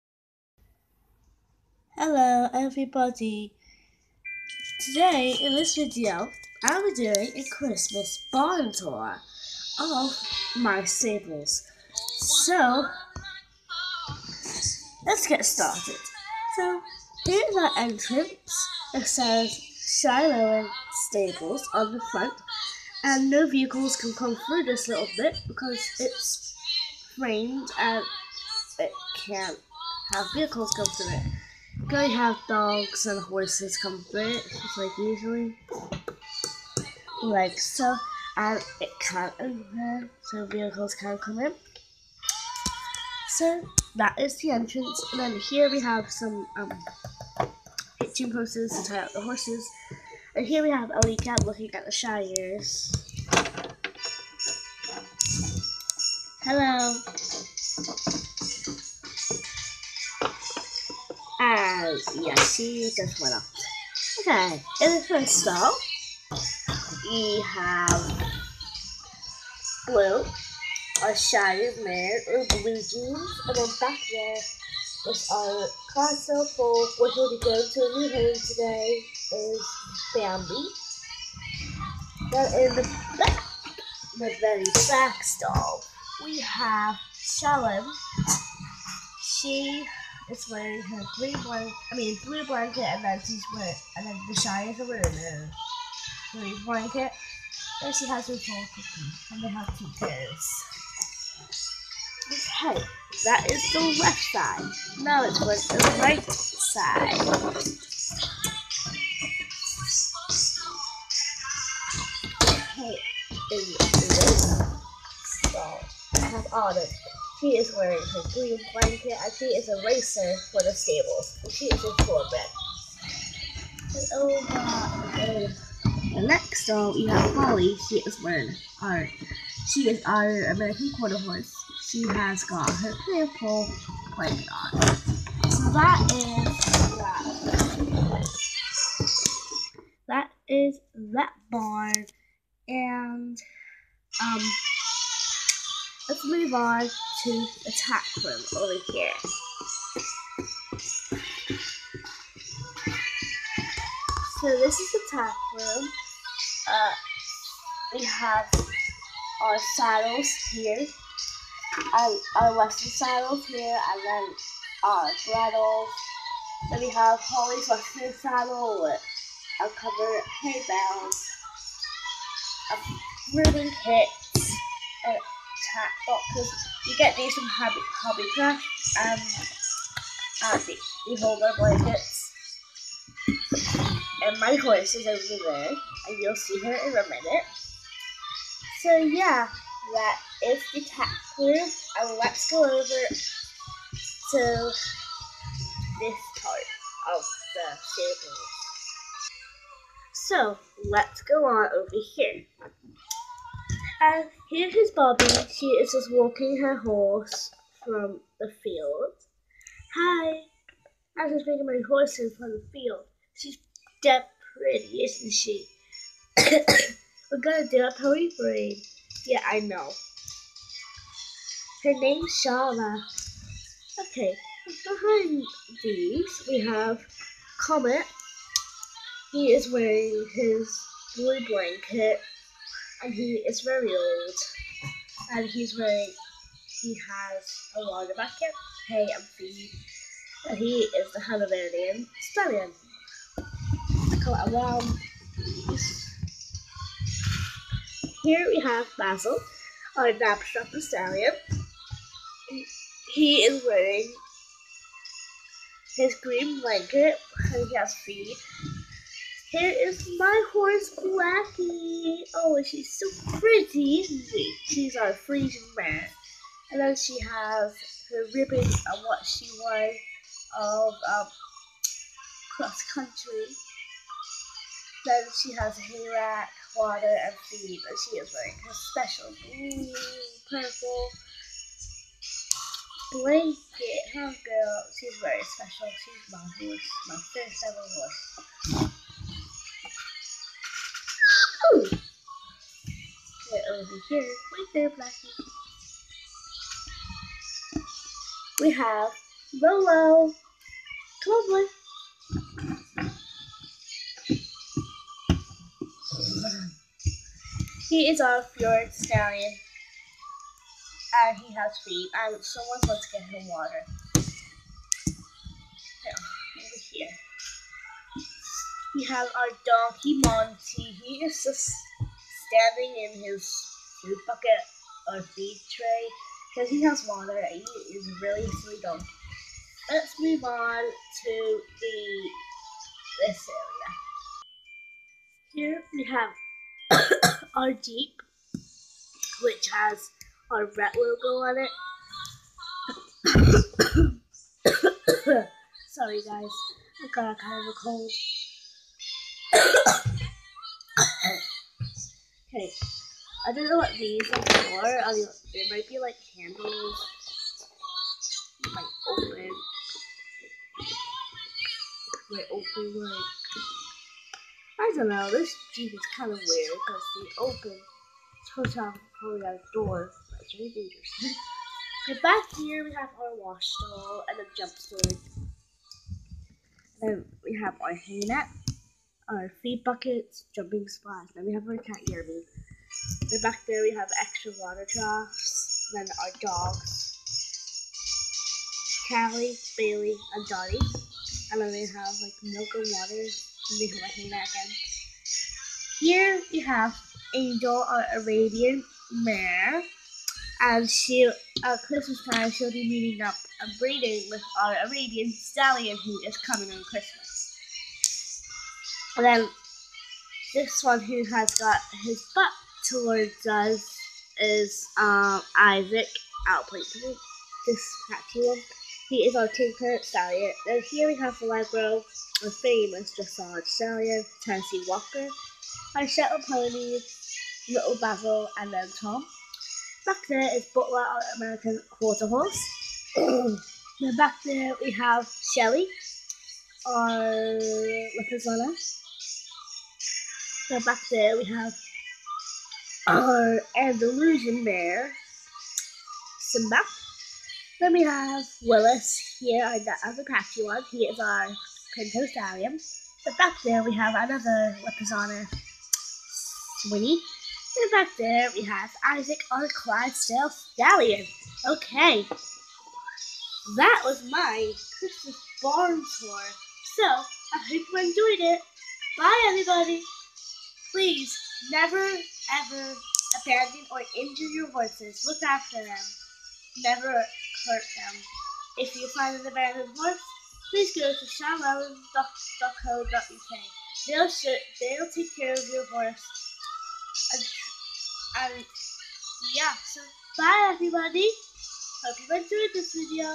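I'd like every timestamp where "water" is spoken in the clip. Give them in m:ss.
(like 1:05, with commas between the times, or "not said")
4:36, 5:13, 5:27, 6:24, 6:32.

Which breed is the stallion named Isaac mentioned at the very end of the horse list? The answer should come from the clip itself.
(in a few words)
Clydesdale.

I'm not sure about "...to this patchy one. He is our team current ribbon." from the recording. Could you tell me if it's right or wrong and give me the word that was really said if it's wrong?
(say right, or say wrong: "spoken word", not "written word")
wrong: "stallion", not "ribbon".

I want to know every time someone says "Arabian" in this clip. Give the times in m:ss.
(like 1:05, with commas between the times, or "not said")
6:38, 6:44.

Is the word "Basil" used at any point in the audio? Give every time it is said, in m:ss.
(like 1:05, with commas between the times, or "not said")
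4:08, 7:07.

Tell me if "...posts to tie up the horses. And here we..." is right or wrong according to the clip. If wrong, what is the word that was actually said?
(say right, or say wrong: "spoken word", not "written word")
right.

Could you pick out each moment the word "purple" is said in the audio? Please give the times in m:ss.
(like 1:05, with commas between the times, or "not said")
2:13, 4:40.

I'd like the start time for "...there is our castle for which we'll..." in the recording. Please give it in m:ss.
1:14.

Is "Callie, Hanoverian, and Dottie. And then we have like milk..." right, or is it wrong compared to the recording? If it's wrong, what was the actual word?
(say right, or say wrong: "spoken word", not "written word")
wrong: "Bailey", not "Hanoverian".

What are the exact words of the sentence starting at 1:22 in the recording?
Then in the back, the very back stall, we have Shalom.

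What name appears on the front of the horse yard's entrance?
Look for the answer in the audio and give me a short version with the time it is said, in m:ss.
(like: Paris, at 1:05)
Shiloh Stables, at 0:19.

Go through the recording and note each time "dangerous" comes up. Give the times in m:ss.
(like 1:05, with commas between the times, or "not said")
6:10.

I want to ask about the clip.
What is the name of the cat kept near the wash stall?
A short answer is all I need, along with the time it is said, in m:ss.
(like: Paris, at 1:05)
Yerby, at 6:22.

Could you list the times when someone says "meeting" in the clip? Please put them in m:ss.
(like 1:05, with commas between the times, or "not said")
6:42.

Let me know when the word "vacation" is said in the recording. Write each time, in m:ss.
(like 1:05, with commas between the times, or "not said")
not said.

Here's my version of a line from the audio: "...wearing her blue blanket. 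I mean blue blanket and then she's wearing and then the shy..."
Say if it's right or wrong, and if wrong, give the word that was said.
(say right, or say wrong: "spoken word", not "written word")
right.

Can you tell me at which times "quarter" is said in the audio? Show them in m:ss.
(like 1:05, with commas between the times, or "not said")
2:10, 7:11.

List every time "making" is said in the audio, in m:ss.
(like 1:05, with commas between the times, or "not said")
3:31.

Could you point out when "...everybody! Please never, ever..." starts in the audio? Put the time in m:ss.
7:49.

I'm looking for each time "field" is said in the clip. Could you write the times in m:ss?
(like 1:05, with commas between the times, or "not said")
3:28, 3:32.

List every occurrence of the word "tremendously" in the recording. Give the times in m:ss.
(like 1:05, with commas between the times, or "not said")
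not said.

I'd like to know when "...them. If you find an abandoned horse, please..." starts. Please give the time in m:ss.
7:57.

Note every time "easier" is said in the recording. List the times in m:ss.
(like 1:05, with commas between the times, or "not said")
not said.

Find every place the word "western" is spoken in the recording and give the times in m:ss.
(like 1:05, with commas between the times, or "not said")
2:42, 2:47.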